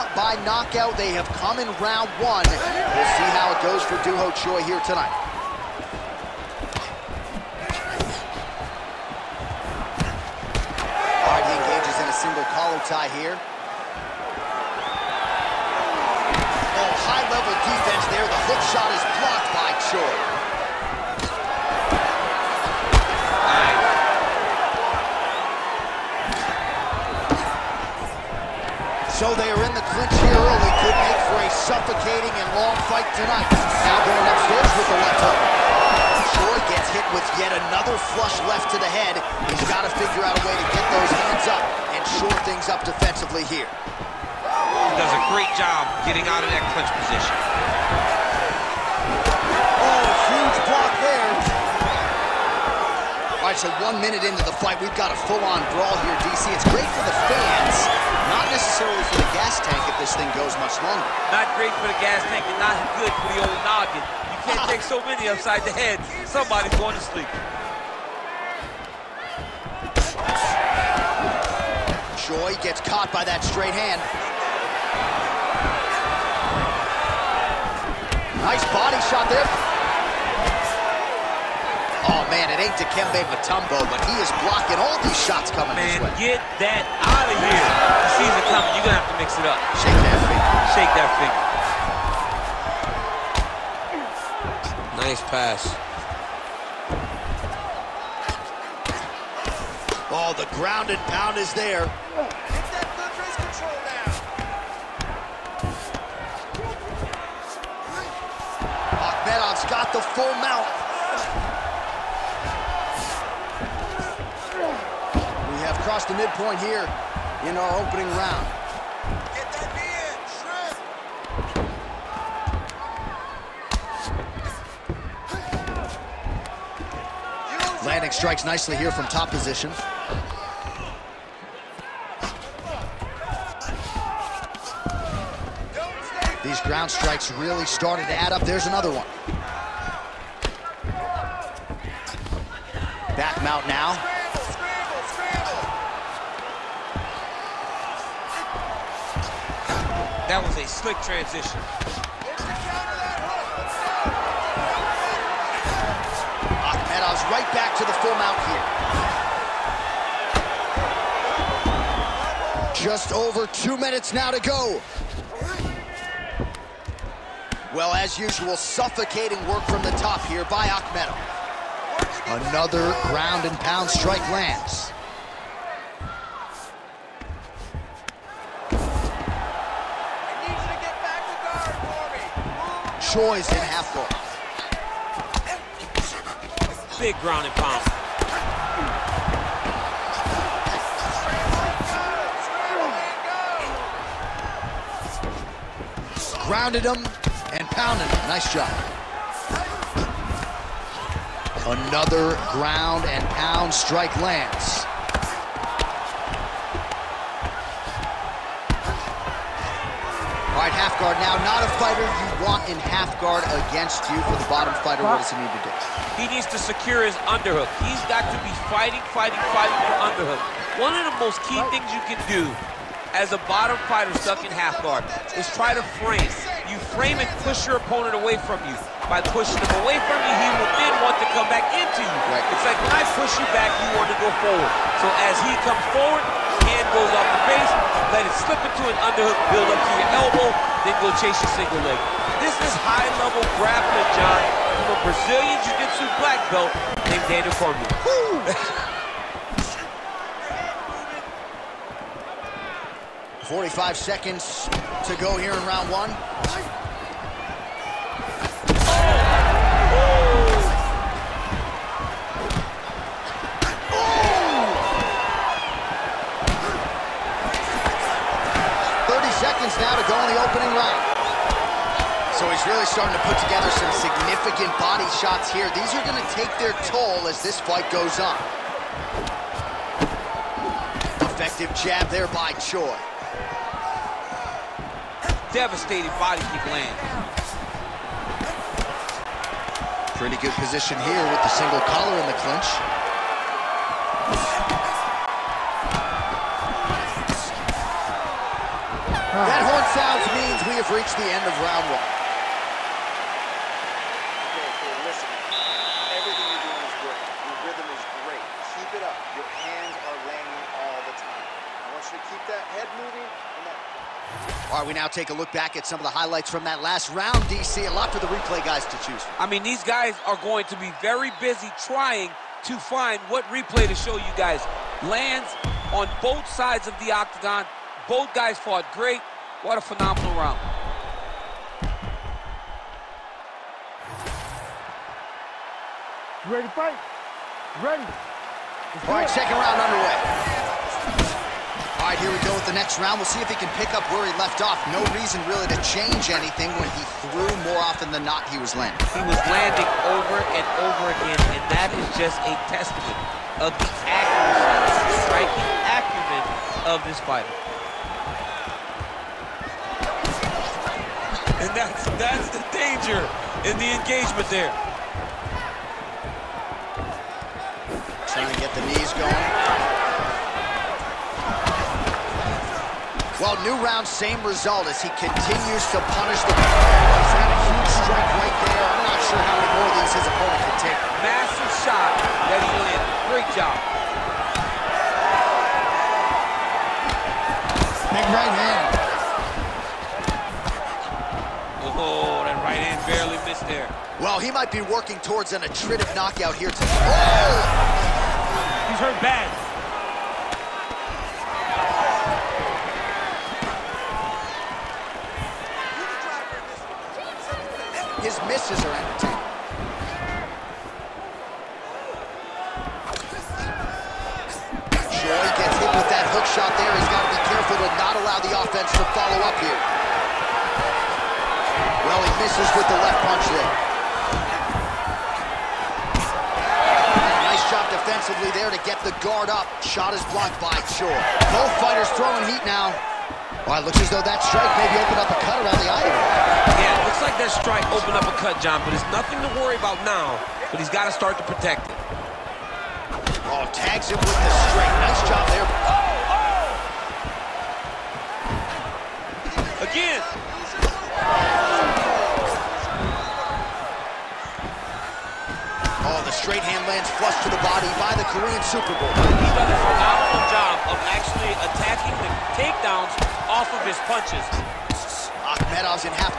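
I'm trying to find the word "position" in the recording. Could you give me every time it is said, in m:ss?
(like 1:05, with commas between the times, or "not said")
0:46, 2:09, 4:50.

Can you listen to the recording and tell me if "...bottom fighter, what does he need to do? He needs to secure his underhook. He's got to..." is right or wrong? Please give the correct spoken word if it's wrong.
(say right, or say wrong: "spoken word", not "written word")
right.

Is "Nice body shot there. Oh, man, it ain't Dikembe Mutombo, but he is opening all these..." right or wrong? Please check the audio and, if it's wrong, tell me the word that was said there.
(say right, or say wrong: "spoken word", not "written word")
wrong: "blocking", not "opening".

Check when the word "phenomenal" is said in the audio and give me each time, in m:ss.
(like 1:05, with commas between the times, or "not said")
5:29, 7:39.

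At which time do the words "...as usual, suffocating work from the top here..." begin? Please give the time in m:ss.
2:47.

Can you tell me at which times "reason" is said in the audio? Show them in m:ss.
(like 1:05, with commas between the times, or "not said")
5:45.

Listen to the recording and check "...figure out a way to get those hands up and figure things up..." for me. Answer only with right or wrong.
wrong.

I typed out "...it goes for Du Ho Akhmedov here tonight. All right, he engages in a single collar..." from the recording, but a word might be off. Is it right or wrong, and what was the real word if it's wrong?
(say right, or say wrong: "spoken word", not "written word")
wrong: "Choi", not "Akhmedov".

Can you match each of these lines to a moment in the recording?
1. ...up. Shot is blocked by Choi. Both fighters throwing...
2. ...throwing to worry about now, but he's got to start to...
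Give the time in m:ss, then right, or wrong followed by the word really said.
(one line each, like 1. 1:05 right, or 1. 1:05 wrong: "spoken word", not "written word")
1. 7:09 right
2. 7:19 wrong: "nothing", not "throwing".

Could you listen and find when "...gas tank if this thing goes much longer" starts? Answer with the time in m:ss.
0:59.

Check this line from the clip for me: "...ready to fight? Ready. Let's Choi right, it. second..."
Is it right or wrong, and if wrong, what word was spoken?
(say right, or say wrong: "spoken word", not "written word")
wrong: "All", not "Choi".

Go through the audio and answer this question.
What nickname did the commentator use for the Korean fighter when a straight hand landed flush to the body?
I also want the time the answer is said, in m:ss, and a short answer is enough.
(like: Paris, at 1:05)
Korean Superboy, at 7:38.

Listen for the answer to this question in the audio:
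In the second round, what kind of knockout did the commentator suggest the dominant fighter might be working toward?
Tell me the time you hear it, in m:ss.
6:35.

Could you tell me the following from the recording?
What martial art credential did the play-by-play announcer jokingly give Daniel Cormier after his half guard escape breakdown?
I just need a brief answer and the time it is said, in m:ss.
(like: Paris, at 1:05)
Brazilian Jiu-Jitsu black belt, at 4:05.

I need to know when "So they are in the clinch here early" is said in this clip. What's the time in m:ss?
0:29.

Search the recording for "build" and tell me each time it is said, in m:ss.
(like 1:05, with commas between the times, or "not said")
3:59.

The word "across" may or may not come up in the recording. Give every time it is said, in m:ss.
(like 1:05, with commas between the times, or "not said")
1:55.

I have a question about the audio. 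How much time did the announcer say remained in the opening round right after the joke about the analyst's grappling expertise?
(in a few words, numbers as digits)
45 seconds.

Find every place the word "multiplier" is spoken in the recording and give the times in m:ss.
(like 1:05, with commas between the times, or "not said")
not said.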